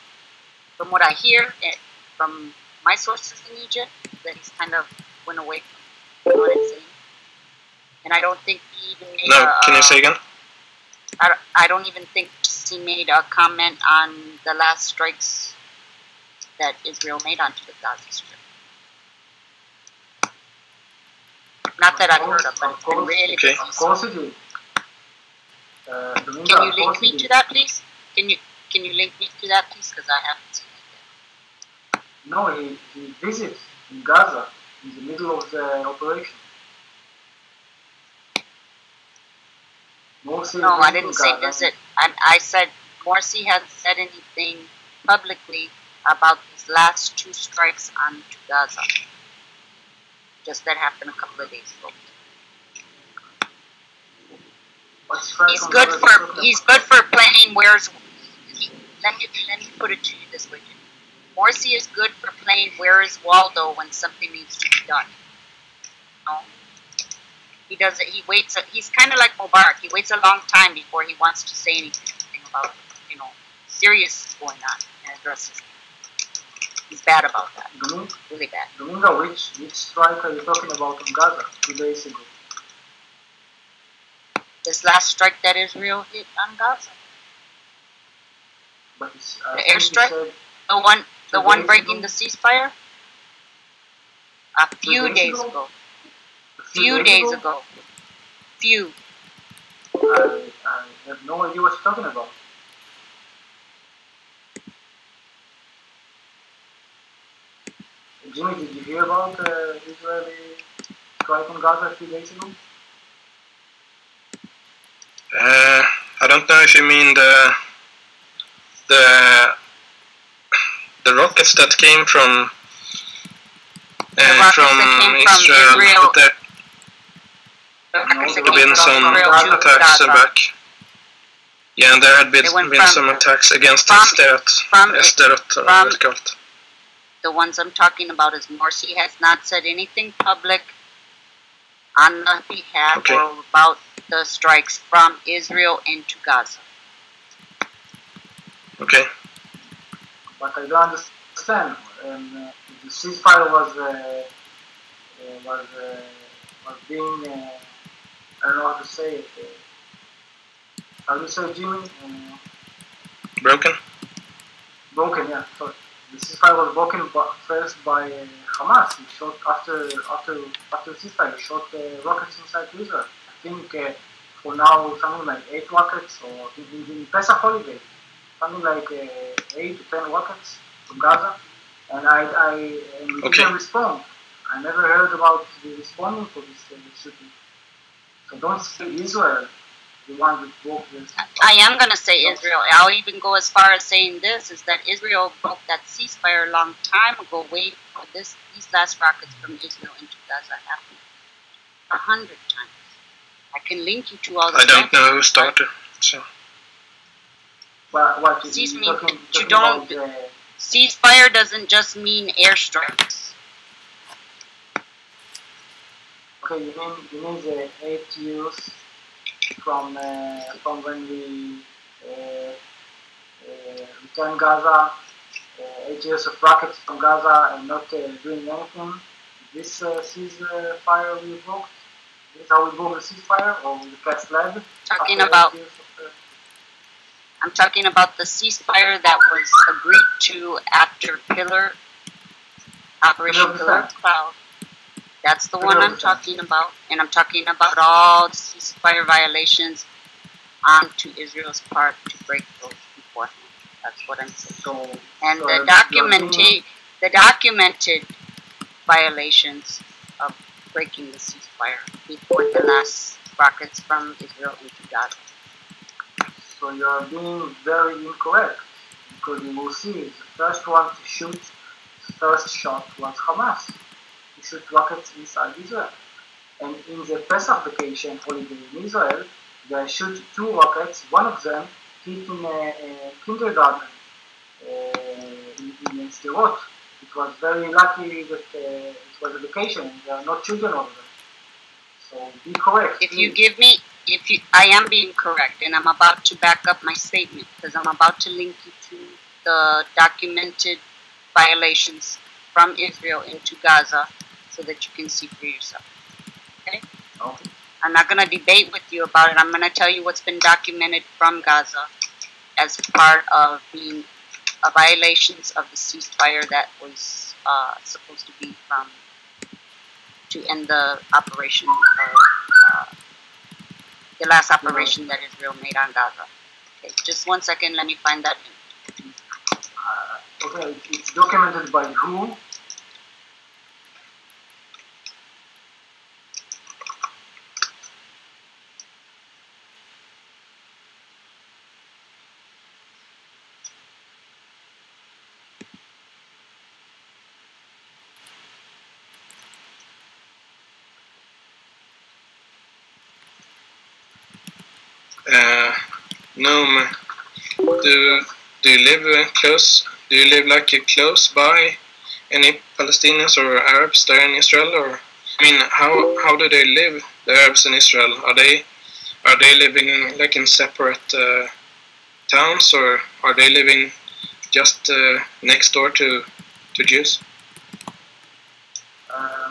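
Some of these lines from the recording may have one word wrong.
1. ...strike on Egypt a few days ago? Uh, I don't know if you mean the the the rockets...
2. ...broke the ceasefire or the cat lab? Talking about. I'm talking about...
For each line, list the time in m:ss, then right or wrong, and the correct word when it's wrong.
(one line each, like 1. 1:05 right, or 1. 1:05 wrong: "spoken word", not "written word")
1. 1:51 wrong: "Gaza", not "Egypt"
2. 3:52 right.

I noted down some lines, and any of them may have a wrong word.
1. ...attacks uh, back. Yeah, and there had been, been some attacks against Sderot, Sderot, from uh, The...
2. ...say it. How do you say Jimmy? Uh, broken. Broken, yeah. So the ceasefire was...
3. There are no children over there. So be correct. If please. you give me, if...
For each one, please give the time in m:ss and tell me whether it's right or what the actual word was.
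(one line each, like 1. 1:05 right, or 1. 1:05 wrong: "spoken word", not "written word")
1. 2:09 right
2. 2:38 right
3. 4:50 right.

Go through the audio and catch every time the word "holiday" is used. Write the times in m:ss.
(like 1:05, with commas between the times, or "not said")
2:57, 4:38.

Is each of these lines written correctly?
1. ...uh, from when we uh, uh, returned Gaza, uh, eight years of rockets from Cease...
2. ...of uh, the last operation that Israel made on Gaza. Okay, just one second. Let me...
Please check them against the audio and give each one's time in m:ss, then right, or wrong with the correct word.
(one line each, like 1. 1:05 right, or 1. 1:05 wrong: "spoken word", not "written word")
1. 3:39 wrong: "Gaza", not "Cease"
2. 5:21 right.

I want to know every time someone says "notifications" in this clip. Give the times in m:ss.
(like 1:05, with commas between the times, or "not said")
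not said.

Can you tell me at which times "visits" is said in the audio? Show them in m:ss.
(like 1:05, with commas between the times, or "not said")
0:33, 0:41.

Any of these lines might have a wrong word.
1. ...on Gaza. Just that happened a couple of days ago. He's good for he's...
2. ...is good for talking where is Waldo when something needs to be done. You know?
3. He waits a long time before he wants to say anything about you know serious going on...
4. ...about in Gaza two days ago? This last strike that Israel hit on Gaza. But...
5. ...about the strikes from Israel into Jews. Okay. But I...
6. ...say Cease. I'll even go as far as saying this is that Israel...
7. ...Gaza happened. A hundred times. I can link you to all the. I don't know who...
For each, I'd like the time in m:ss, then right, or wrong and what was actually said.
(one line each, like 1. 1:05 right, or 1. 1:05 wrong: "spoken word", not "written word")
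1. 0:48 right
2. 1:01 wrong: "playing", not "talking"
3. 1:09 right
4. 1:20 right
5. 2:23 wrong: "Gaza", not "Jews"
6. 3:11 wrong: "Israel", not "Cease"
7. 3:20 right.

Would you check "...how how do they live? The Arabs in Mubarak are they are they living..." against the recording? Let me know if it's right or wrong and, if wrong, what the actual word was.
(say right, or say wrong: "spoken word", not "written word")
wrong: "Israel", not "Mubarak".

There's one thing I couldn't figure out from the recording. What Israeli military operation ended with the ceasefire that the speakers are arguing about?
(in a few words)
Operation Pillar Cloud.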